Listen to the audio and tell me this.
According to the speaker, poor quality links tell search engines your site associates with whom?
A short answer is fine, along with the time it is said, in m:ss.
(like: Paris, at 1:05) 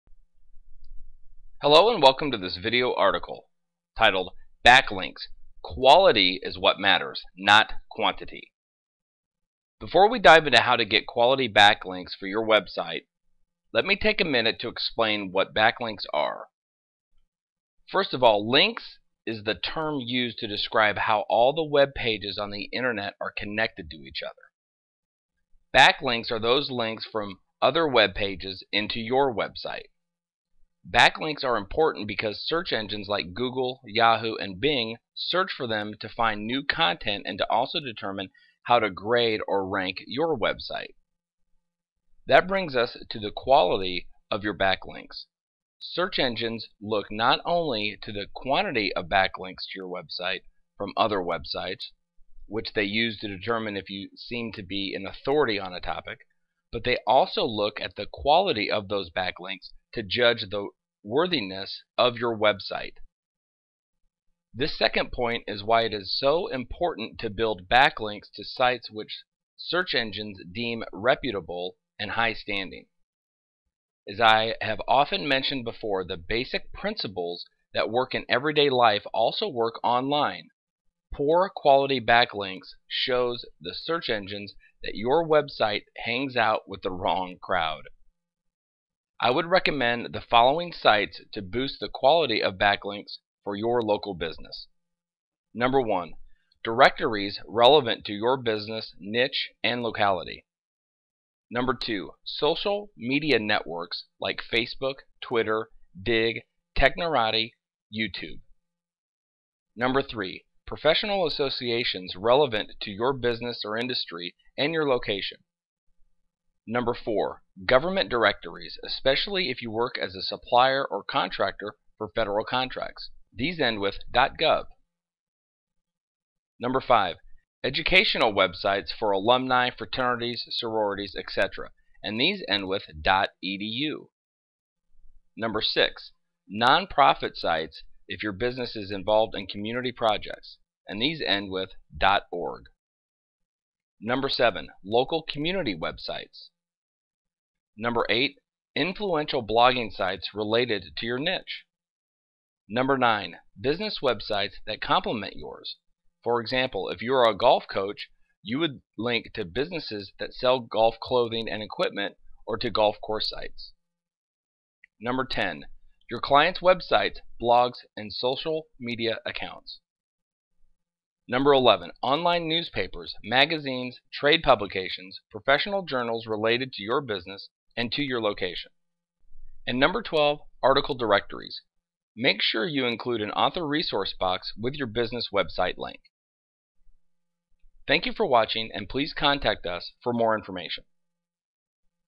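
the wrong crowd, at 1:26.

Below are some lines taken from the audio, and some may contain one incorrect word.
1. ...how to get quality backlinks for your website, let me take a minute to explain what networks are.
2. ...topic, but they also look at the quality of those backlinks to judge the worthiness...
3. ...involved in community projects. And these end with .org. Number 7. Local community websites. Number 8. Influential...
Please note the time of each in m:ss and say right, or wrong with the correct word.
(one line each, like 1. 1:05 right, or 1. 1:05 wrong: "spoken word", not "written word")
1. 0:10 wrong: "backlinks", not "networks"
2. 0:55 right
3. 2:18 right.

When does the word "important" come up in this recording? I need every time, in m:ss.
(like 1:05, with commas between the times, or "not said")
0:31, 1:06.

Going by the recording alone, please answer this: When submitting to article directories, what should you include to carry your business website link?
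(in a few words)
author resource box.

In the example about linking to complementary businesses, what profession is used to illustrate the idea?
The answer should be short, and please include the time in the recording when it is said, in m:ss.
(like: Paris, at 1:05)
golf coach, at 2:37.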